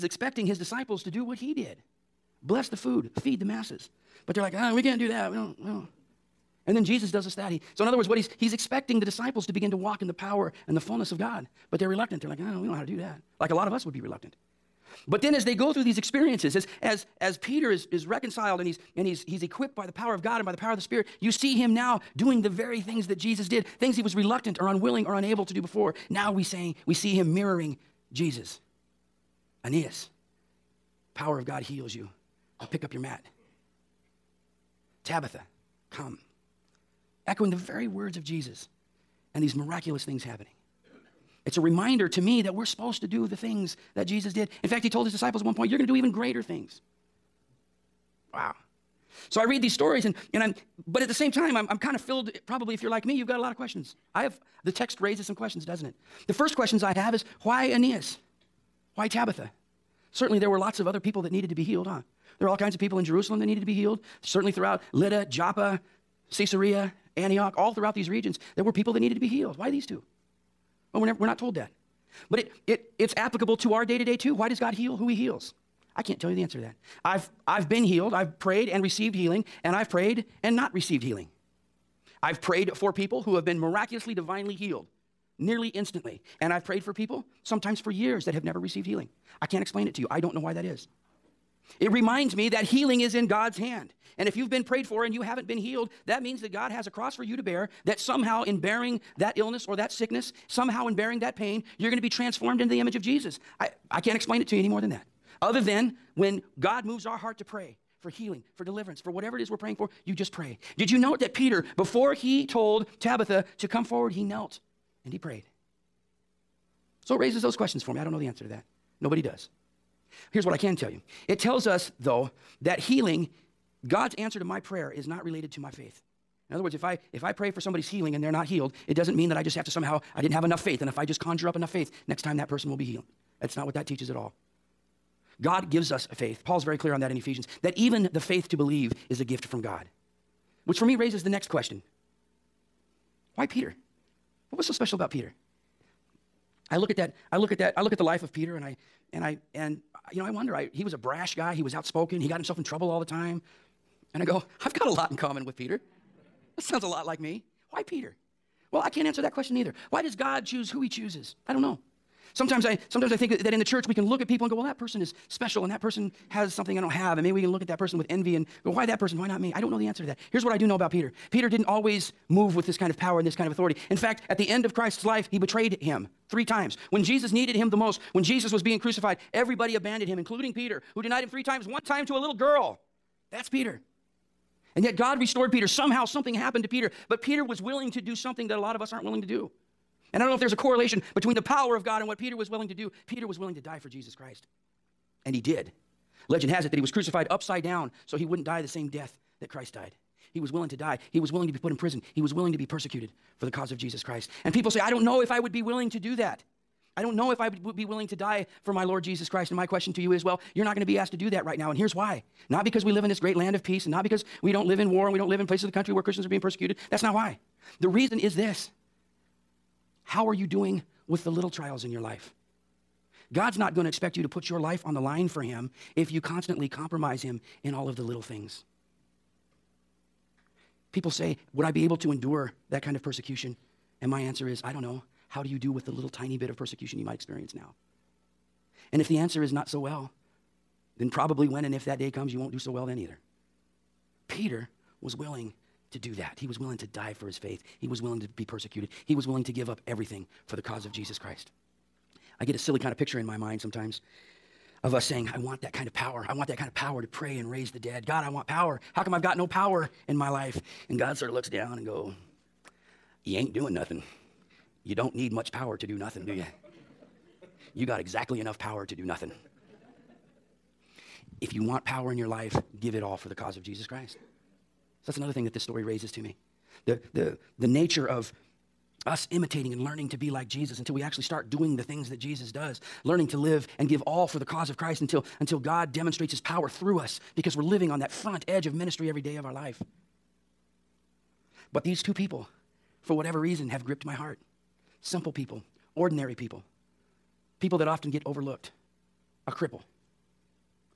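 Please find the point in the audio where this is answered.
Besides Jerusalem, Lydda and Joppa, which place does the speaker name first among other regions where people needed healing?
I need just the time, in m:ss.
1:06.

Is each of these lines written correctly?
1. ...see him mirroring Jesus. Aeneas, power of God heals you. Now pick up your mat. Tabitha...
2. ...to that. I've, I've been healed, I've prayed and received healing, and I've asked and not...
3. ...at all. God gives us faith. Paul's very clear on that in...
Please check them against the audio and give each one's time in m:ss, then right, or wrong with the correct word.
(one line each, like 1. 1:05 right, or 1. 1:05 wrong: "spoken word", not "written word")
1. 0:26 right
2. 1:16 wrong: "prayed", not "asked"
3. 2:14 right.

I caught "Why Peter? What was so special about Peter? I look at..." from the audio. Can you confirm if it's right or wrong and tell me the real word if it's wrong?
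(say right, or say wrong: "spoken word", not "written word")
right.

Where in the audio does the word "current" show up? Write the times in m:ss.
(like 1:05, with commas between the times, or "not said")
not said.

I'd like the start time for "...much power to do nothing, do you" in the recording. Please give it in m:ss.
4:25.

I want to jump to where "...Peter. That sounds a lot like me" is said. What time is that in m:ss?
2:35.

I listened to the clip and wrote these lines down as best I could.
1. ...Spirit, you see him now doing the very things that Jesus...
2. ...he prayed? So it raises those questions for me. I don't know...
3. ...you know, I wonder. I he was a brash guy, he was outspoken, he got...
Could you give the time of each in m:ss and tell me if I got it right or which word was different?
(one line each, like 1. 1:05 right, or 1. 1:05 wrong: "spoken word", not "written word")
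1. 0:20 right
2. 1:55 right
3. 2:30 right.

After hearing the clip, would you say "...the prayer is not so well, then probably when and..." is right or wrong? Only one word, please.
wrong.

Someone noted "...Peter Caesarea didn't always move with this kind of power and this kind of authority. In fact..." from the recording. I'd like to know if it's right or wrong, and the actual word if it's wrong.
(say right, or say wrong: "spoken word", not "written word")
wrong: "Peter", not "Caesarea".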